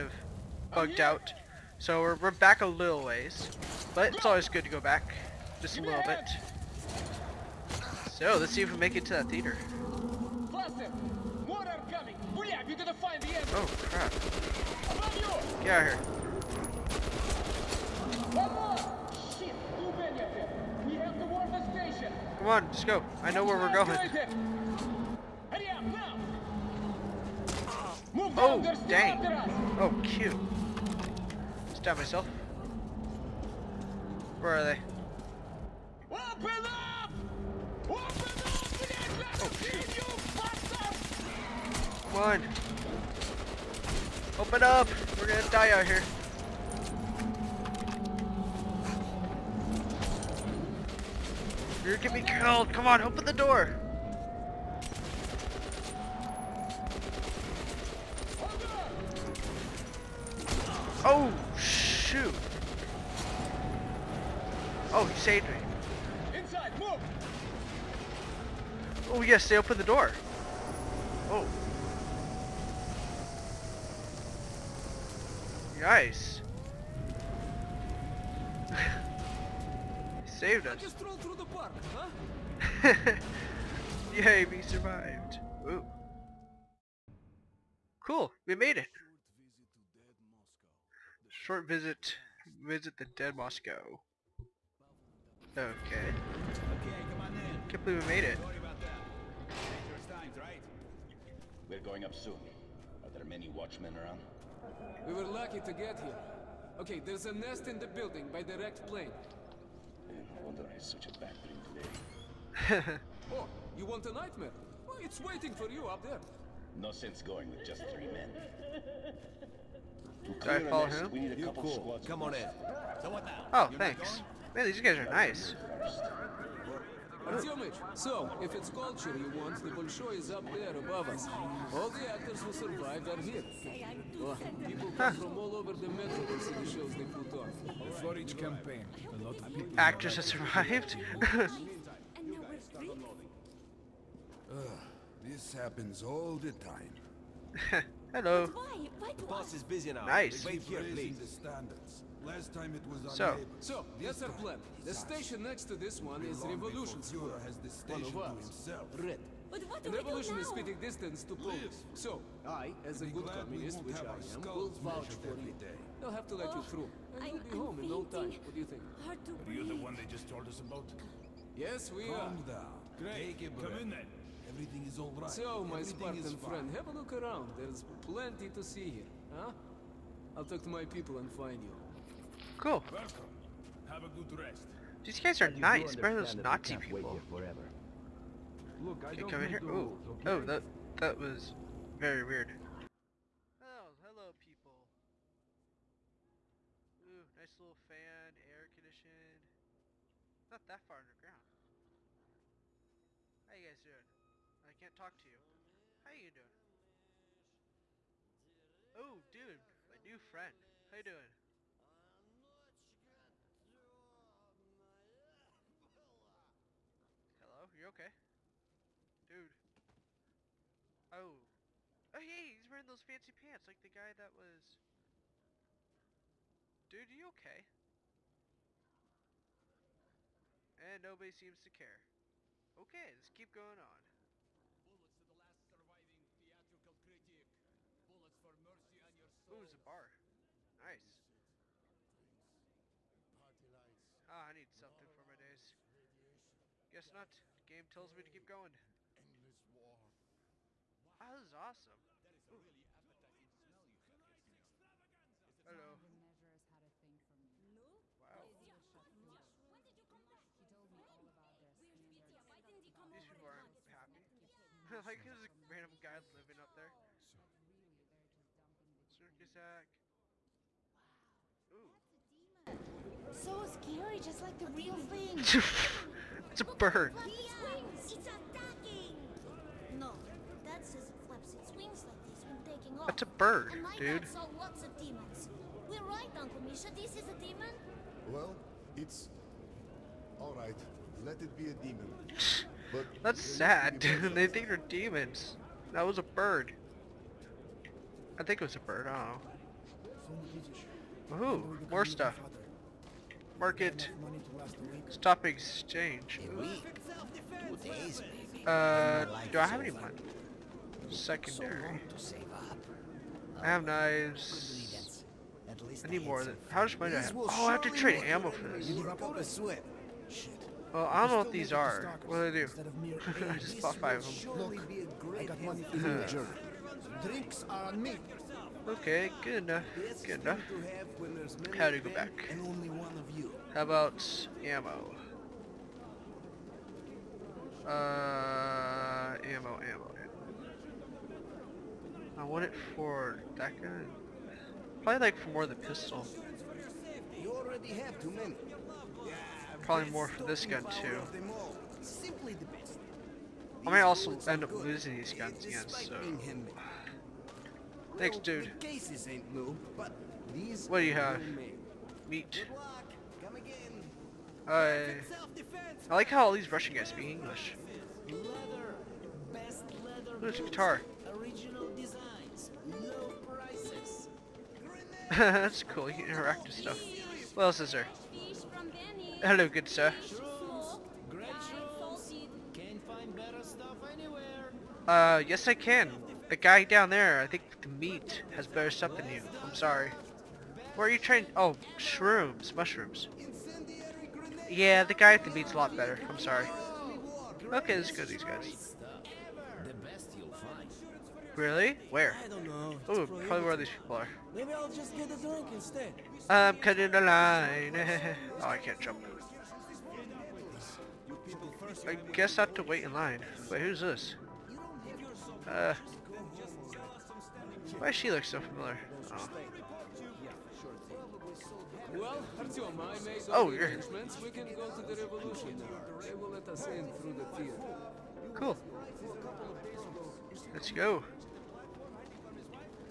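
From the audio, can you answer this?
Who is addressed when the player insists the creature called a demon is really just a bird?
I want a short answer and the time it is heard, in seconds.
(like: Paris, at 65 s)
Uncle Misha, at 286 s.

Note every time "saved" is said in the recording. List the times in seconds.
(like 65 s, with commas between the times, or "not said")
65 s, 80 s.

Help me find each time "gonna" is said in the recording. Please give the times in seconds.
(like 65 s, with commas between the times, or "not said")
12 s, 45 s, 51 s.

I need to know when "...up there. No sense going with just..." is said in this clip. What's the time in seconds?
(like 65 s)
115 s.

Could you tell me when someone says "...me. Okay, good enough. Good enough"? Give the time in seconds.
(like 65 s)
328 s.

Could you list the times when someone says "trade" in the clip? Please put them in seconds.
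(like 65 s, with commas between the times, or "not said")
317 s.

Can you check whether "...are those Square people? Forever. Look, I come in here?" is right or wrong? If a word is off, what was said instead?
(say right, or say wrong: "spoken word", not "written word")
wrong: "Nazi", not "Square".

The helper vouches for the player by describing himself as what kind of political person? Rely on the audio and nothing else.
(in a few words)
a good communist.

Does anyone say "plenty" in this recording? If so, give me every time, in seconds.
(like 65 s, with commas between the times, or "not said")
178 s.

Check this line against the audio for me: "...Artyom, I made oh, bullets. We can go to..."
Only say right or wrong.
wrong.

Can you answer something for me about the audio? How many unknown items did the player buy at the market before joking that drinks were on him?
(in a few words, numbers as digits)
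5.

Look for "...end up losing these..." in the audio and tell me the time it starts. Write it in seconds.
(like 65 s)
354 s.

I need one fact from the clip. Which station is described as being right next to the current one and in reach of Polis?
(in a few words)
Revolution Square.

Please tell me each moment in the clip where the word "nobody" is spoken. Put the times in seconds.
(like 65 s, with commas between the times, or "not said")
231 s.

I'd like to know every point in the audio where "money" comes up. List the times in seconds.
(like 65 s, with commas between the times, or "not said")
309 s, 316 s.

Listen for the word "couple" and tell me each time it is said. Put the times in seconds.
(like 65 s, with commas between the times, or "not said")
121 s.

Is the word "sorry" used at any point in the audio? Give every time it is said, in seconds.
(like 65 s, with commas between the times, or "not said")
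389 s, 396 s.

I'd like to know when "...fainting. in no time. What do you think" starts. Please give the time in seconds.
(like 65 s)
167 s.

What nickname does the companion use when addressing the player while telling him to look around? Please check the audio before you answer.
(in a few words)
Spartan friend.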